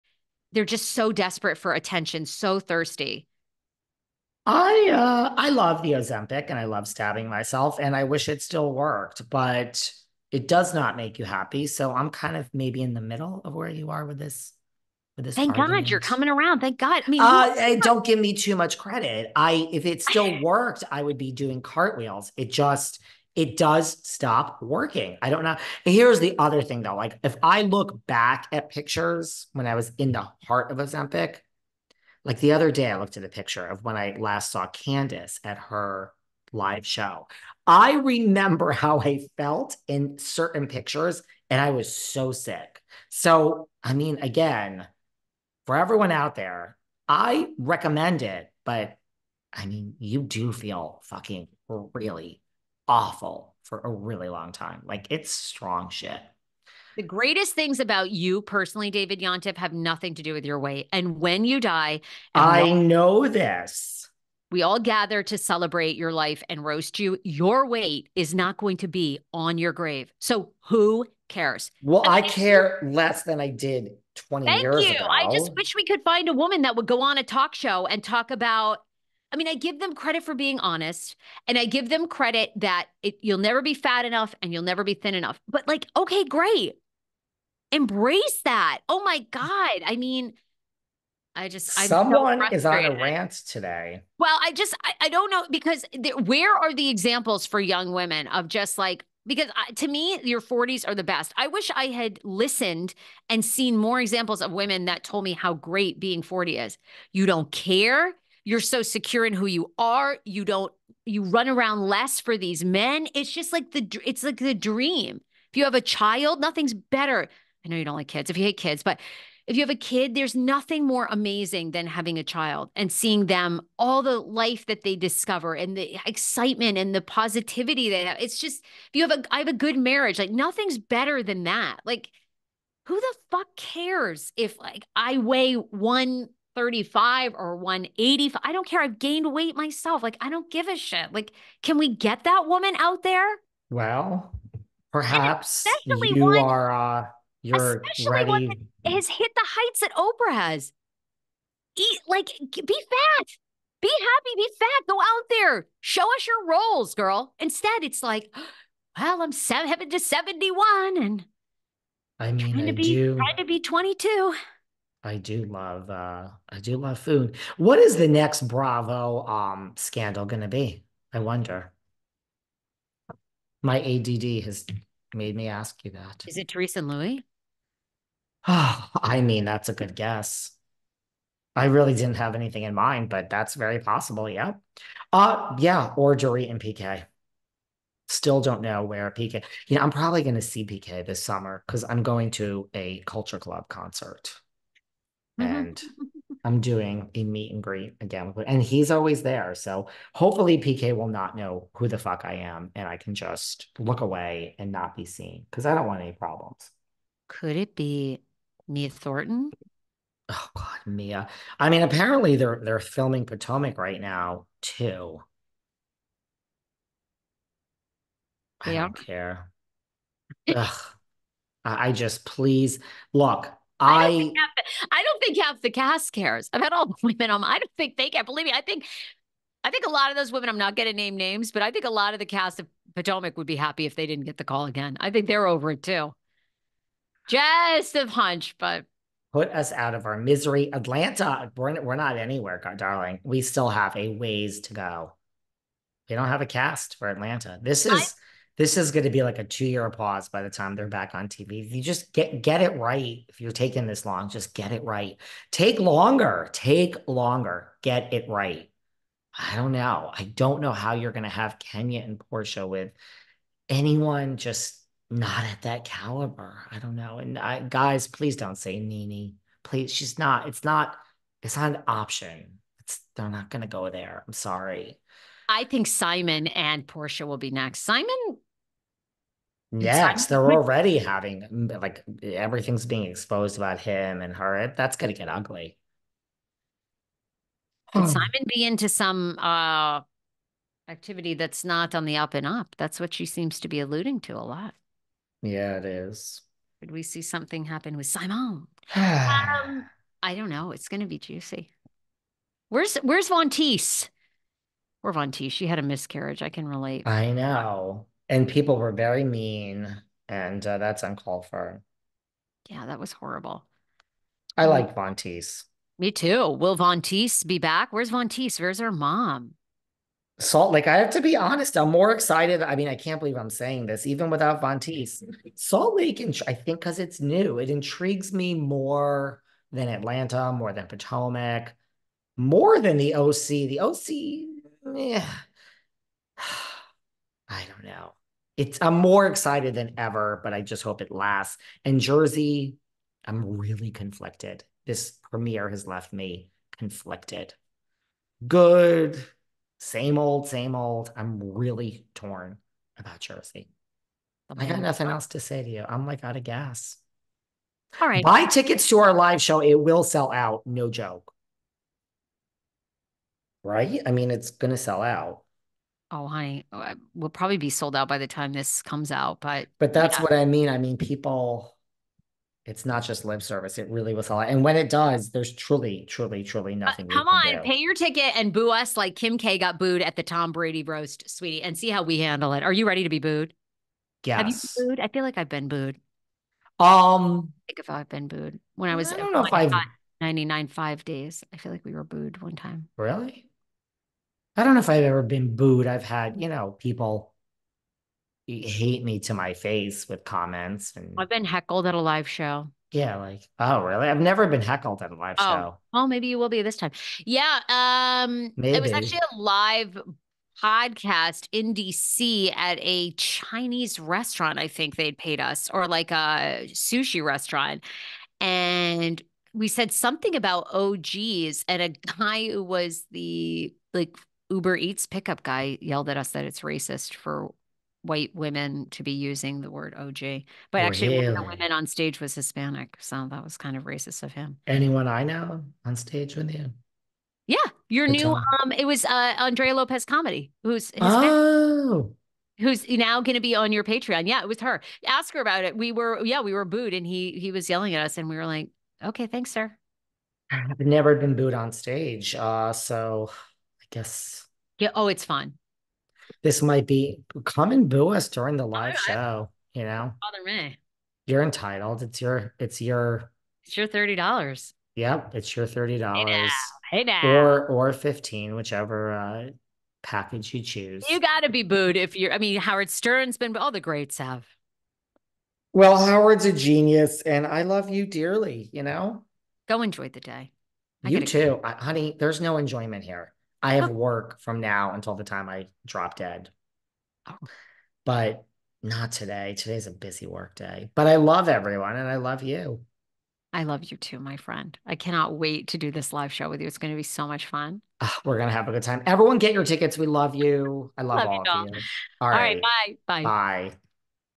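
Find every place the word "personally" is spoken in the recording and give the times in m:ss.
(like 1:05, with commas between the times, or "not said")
0:58.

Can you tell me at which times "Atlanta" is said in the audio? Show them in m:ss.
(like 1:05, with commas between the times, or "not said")
4:00, 4:07, 5:29.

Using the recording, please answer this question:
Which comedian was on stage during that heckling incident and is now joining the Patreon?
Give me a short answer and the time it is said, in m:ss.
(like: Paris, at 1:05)
Andrea Lopez, at 7:19.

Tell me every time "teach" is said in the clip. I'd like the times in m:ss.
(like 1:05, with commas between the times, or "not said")
not said.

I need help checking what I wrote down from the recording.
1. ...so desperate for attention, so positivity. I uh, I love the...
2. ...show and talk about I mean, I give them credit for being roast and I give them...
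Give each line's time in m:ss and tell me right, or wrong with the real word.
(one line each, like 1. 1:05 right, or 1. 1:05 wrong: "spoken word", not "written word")
1. 0:00 wrong: "thirsty", not "positivity"
2. 1:17 wrong: "honest", not "roast".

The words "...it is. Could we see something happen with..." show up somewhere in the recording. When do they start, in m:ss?
4:55.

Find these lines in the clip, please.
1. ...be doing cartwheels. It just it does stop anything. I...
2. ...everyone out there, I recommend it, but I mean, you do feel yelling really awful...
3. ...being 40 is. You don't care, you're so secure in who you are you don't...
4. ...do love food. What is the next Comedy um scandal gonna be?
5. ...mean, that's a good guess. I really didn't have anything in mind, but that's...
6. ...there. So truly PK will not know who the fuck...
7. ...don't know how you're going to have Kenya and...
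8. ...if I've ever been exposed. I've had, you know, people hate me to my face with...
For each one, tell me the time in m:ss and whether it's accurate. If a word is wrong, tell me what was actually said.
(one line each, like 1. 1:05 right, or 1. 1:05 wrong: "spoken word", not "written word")
1. 0:21 wrong: "working", not "anything"
2. 0:45 wrong: "fucking", not "yelling"
3. 1:46 right
4. 2:46 wrong: "Bravo", not "Comedy"
5. 2:59 right
6. 3:19 wrong: "hopefully", not "truly"
7. 4:20 right
8. 6:34 wrong: "booed", not "exposed".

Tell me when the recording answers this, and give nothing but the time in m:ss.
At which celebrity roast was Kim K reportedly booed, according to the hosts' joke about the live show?
6:20.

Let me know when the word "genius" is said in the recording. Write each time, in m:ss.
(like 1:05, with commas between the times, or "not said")
7:56.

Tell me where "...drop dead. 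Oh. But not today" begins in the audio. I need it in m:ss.
8:05.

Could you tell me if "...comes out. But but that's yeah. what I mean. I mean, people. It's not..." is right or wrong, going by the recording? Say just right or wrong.
right.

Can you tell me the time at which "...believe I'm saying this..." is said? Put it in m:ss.
5:23.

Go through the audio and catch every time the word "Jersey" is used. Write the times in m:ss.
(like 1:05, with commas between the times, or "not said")
5:41, 5:53.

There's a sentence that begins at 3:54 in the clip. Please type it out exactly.
I think they're over it too.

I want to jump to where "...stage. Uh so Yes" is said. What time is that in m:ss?
7:31.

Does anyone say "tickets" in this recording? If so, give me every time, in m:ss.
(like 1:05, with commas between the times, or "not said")
5:58, 6:17, 8:19.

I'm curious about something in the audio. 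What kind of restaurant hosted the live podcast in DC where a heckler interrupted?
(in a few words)
sushi restaurant.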